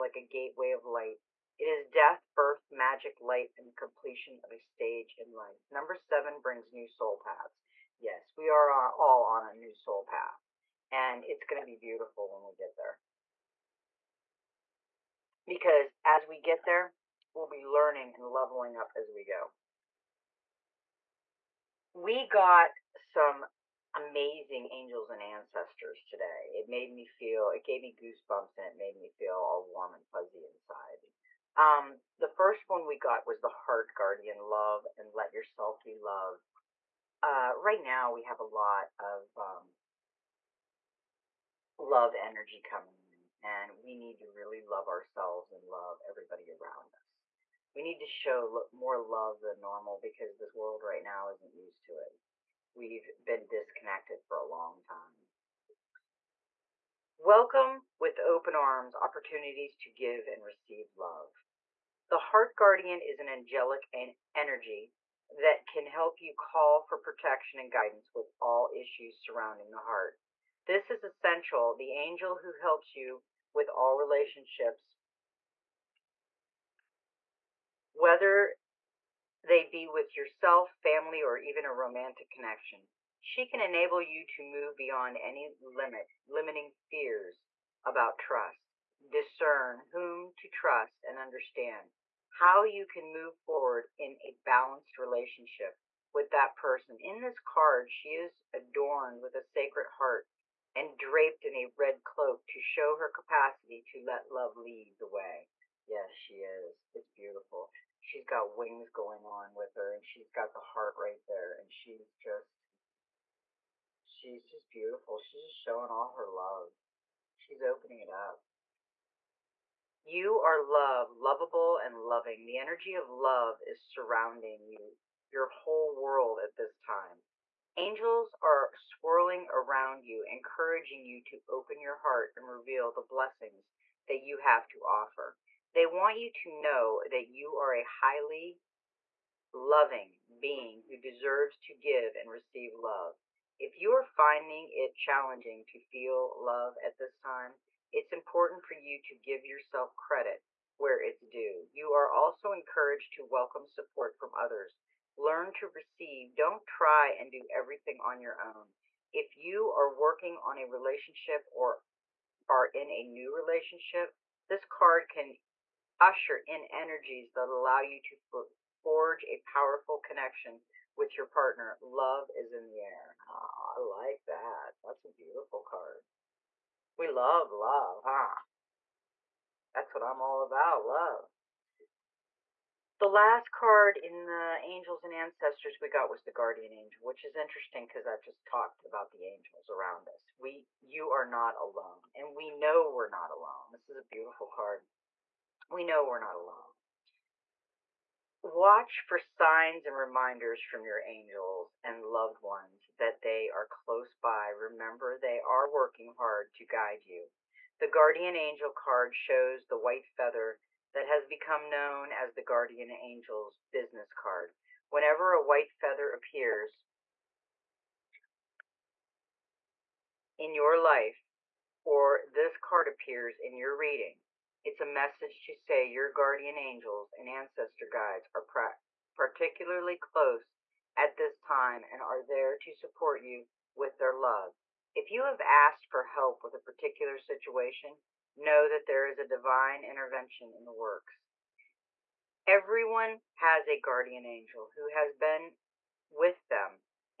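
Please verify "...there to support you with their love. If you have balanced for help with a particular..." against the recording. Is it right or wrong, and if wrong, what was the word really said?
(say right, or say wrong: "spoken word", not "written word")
wrong: "asked", not "balanced".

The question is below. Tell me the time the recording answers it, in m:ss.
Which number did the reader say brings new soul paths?
0:05.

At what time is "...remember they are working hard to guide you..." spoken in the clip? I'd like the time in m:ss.
3:24.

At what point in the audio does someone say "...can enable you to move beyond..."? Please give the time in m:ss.
1:23.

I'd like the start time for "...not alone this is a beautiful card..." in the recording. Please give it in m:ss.
3:13.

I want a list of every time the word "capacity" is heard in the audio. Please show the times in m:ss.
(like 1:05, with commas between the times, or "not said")
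1:43.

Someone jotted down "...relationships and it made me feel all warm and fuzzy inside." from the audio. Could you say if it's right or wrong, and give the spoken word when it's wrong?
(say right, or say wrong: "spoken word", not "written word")
wrong: "goosebumps", not "relationships".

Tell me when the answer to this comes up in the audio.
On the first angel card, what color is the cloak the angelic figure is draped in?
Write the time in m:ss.
1:41.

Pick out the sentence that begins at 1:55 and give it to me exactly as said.
She's just showing all her love.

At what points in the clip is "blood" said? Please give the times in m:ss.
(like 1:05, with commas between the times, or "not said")
not said.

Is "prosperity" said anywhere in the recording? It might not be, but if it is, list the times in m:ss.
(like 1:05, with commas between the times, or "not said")
not said.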